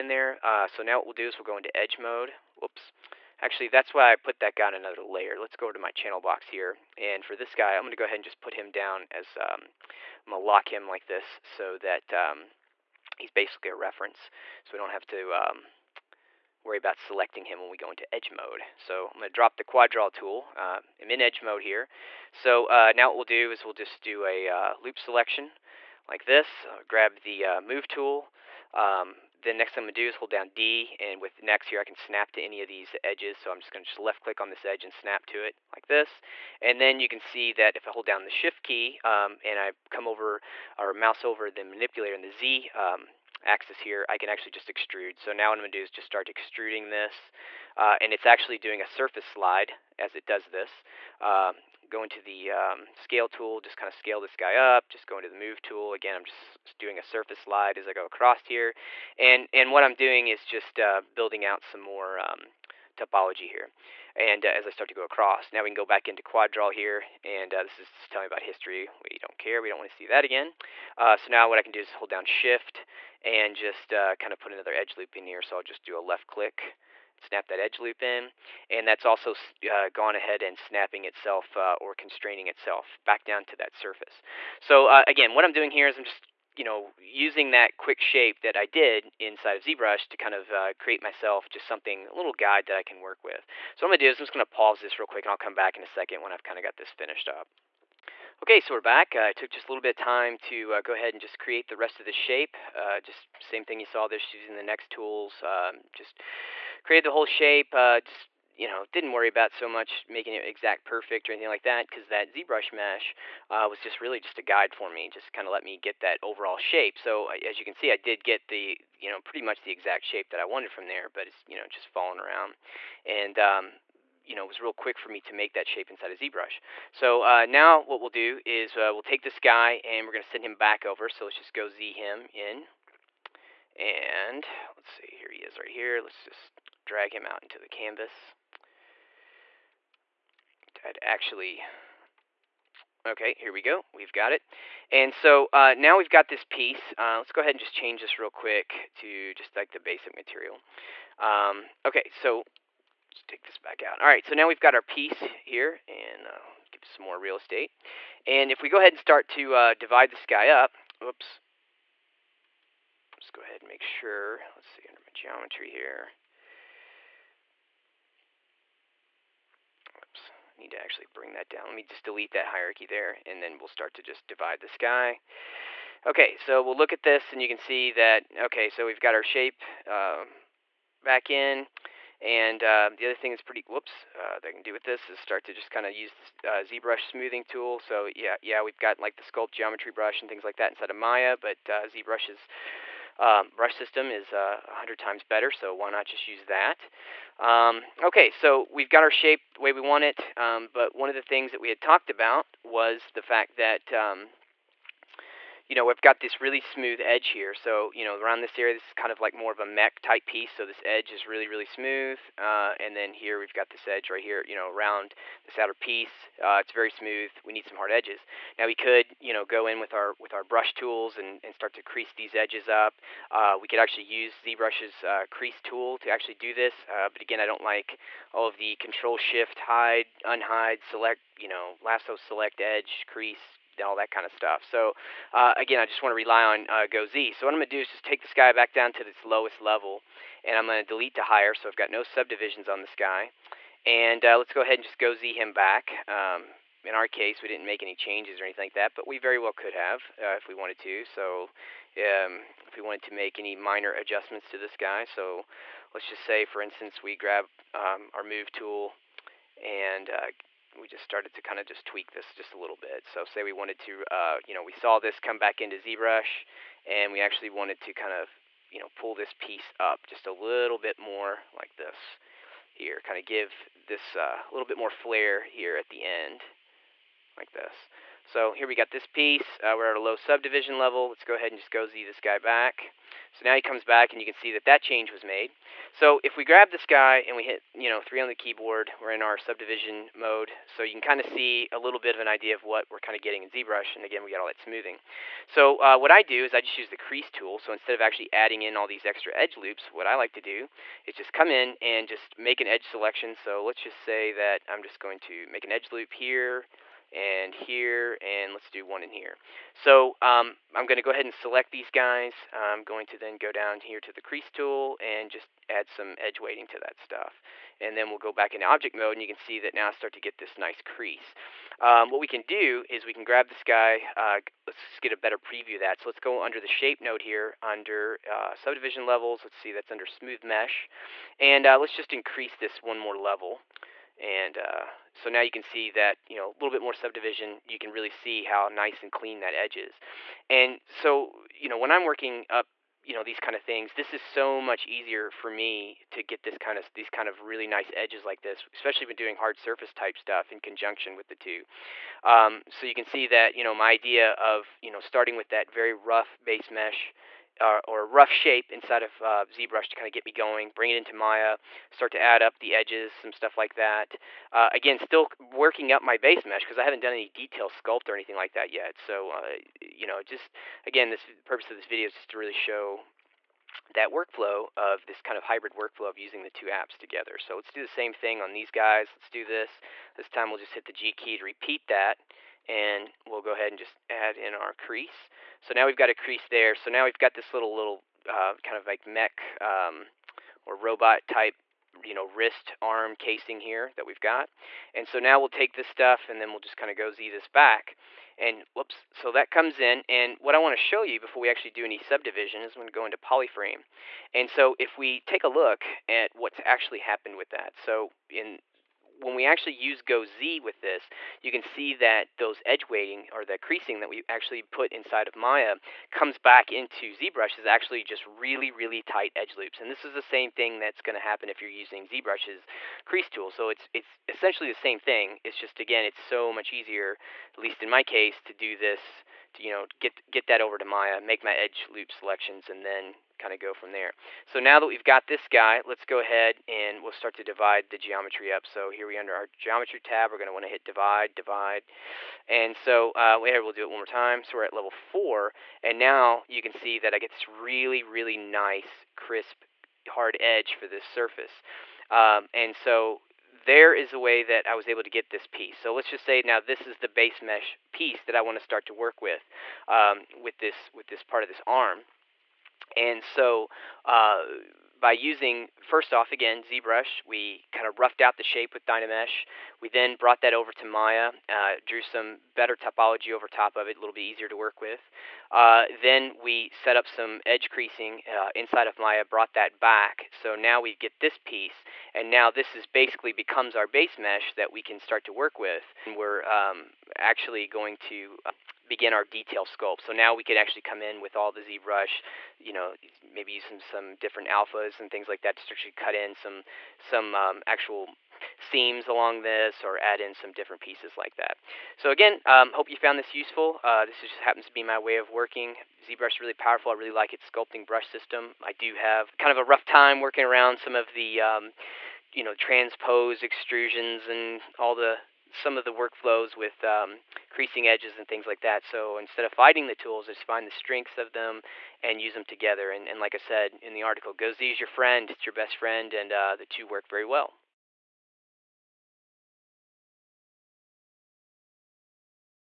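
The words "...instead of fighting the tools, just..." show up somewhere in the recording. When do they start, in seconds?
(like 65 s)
519 s.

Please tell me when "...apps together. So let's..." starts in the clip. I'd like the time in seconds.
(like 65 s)
376 s.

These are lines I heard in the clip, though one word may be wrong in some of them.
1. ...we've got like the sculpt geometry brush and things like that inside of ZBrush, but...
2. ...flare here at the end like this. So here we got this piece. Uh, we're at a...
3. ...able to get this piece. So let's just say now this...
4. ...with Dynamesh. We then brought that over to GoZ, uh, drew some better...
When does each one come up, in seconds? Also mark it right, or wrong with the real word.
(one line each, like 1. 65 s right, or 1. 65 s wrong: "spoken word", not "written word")
1. 188 s wrong: "Maya", not "ZBrush"
2. 274 s right
3. 454 s right
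4. 468 s wrong: "Maya", not "GoZ".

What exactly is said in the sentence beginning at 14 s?
So we don't have to um, worry about selecting him when we go into edge mode.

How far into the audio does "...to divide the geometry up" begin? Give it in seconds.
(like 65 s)
437 s.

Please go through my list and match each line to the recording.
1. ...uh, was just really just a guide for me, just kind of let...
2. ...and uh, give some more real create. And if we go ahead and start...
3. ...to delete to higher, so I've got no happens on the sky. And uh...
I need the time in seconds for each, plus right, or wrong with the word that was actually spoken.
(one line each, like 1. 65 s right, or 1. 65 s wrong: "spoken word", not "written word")
1. 113 s right
2. 155 s wrong: "estate", not "create"
3. 240 s wrong: "subdivisions", not "happens".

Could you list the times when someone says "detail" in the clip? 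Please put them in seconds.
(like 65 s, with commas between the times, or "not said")
367 s, 489 s.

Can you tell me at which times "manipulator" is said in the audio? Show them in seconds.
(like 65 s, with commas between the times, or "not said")
41 s.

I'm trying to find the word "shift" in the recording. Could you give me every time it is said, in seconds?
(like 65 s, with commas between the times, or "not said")
38 s, 72 s, 229 s.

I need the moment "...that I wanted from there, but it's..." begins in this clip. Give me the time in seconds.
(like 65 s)
120 s.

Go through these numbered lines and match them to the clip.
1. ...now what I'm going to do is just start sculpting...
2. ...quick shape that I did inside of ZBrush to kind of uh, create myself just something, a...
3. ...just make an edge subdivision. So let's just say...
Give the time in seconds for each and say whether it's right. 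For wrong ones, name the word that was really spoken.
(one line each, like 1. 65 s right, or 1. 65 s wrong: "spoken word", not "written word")
1. 45 s wrong: "extruding", not "sculpting"
2. 87 s right
3. 302 s wrong: "selection", not "subdivision".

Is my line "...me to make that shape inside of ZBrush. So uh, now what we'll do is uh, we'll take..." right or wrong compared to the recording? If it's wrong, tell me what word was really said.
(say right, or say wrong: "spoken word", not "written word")
right.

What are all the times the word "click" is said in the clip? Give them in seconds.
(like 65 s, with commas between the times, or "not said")
34 s, 76 s.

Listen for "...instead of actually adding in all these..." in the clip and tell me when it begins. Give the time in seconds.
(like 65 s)
297 s.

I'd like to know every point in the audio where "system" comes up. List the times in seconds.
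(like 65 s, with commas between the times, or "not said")
193 s, 508 s.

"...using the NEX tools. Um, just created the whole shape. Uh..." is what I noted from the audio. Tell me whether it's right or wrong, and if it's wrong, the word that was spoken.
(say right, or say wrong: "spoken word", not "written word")
right.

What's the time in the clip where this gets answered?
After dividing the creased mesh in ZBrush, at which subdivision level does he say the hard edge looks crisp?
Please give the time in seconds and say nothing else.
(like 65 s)
444 s.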